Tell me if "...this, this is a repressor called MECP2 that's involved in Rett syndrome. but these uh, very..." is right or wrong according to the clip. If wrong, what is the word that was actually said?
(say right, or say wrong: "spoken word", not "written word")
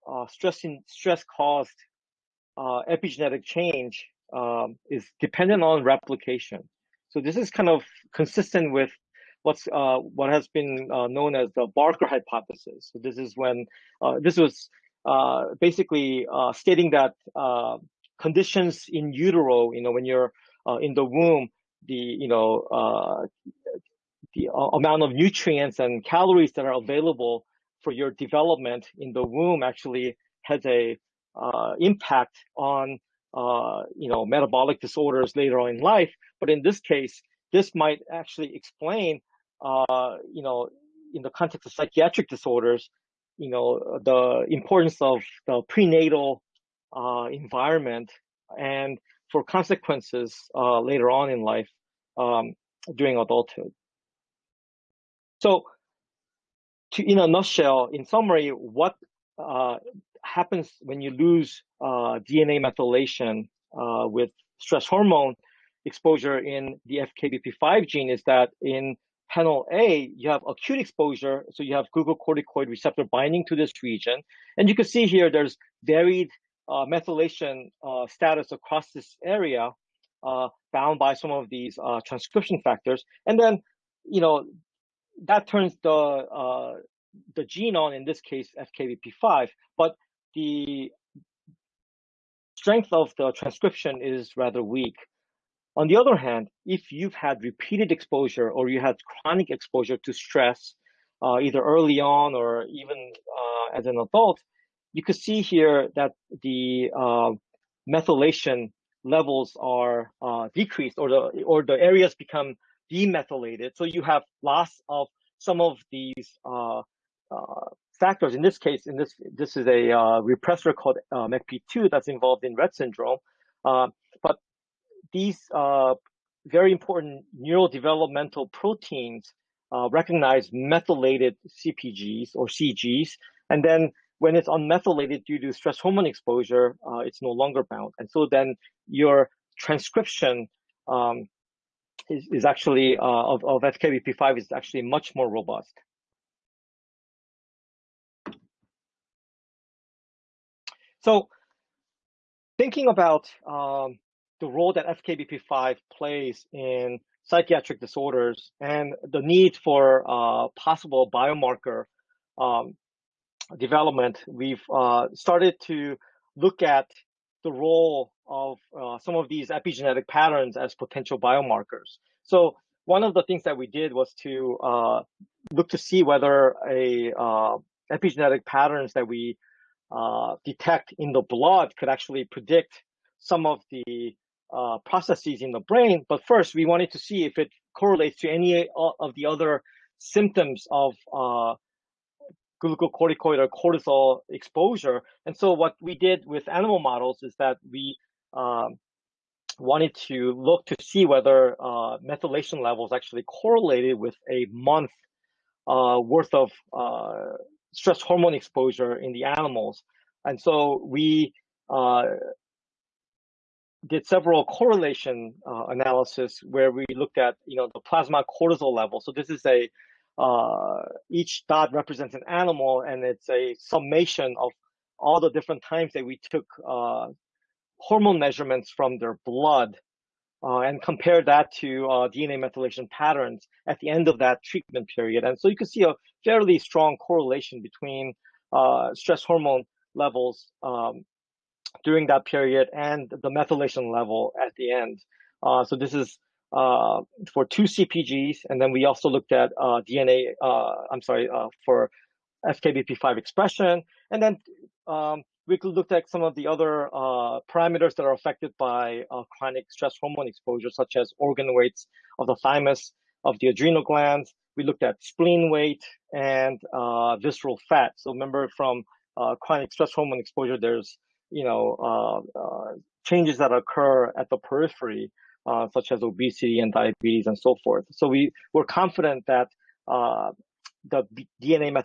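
right.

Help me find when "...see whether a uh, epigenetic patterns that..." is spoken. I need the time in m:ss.
2:55.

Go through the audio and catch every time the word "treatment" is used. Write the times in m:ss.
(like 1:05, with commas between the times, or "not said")
3:54.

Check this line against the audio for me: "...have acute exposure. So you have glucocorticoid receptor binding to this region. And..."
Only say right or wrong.
right.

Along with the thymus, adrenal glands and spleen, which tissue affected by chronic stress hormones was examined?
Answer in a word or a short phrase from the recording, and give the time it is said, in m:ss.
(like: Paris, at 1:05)
visceral fat, at 4:27.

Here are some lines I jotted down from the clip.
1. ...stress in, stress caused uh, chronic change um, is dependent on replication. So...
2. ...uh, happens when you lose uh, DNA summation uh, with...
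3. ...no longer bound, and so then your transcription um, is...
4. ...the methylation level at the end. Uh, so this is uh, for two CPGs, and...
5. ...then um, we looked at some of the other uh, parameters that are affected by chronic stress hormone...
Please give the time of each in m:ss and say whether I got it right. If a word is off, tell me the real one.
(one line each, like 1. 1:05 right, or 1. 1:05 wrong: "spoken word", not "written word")
1. 0:00 wrong: "epigenetic", not "chronic"
2. 0:59 wrong: "methylation", not "summation"
3. 2:17 right
4. 4:03 right
5. 4:14 right.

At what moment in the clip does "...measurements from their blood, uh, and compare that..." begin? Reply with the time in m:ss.
3:48.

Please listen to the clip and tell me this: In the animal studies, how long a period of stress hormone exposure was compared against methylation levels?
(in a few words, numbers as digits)
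a month.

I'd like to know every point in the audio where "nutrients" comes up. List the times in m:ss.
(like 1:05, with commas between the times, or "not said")
0:25.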